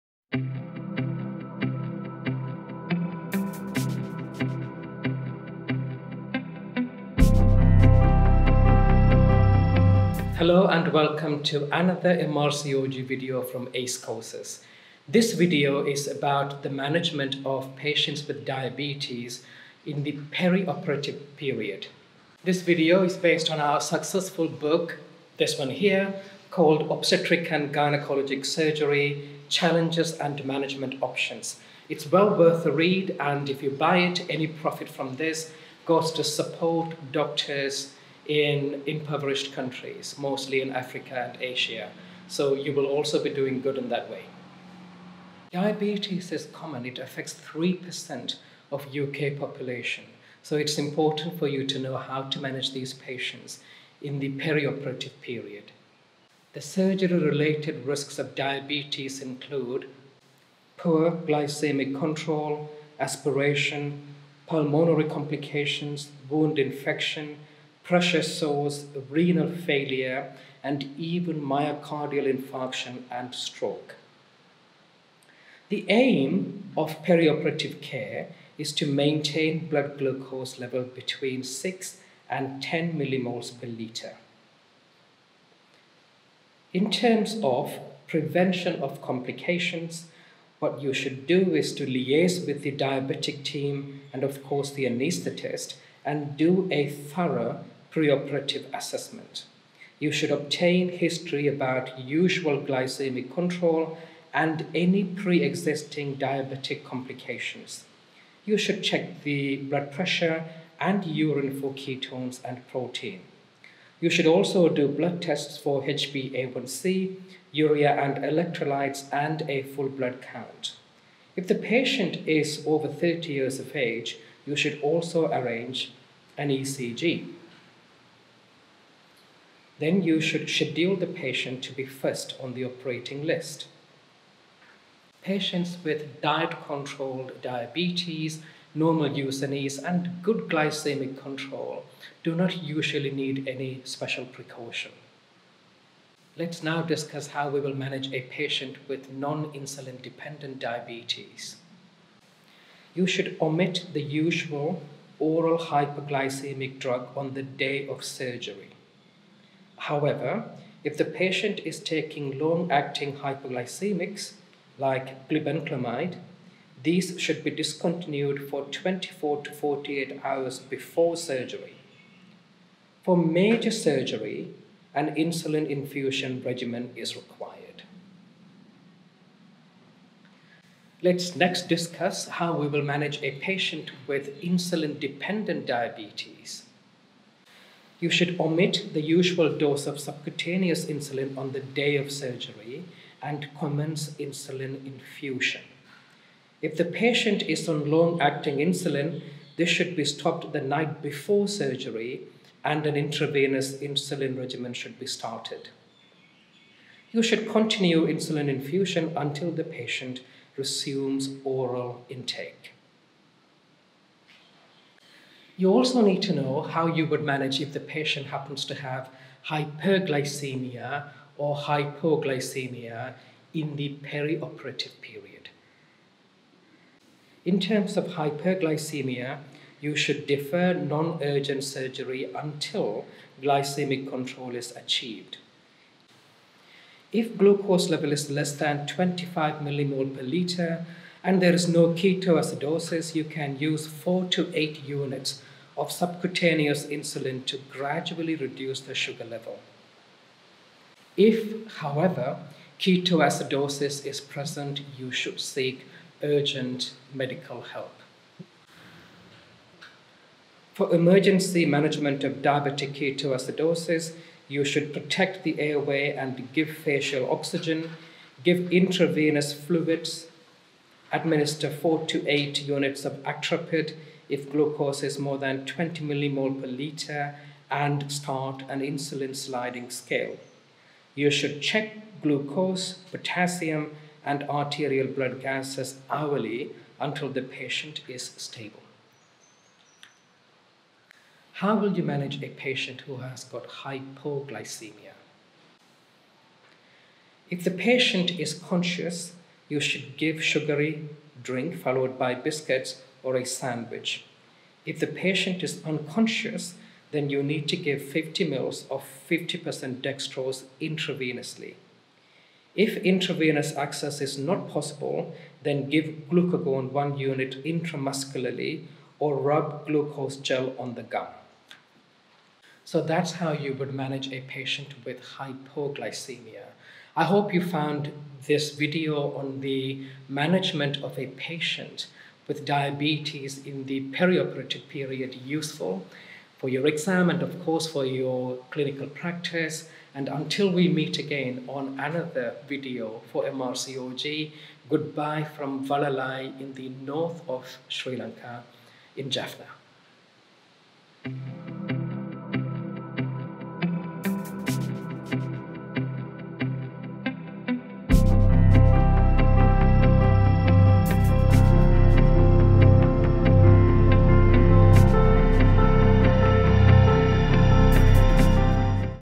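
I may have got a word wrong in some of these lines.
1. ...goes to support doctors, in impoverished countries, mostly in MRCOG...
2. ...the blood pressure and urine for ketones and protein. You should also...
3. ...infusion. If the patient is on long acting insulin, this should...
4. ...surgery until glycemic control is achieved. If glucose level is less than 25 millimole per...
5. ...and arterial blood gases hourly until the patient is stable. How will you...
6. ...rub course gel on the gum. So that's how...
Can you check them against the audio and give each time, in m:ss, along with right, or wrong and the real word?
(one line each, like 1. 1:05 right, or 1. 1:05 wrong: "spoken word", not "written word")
1. 0:35 wrong: "Africa", not "MRCOG"
2. 1:49 right
3. 3:14 right
4. 3:51 right
5. 4:44 right
6. 5:19 wrong: "glucose", not "course".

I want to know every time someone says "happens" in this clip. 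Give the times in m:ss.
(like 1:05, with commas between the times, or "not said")
3:38.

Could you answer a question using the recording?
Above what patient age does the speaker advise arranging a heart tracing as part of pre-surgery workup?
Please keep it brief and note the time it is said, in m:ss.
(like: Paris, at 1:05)
30 years, at 2:02.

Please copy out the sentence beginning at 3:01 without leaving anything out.
Let's next discuss how we will manage a patient with insulin-dependent diabetes.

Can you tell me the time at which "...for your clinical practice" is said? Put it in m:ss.
5:37.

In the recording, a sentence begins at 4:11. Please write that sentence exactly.
If, however, ketoacidosis is present, you should seek urgent medical help.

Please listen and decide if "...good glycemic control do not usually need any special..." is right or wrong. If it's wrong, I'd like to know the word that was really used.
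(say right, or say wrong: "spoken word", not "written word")
right.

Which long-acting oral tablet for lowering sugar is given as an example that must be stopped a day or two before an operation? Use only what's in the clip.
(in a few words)
Glibenclamide.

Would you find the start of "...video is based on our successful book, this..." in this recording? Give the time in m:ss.
0:22.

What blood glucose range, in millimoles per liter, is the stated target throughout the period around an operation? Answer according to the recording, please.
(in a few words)
6 to 10.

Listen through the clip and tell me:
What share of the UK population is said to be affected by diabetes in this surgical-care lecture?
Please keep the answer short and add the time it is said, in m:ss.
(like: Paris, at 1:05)
3%, at 0:47.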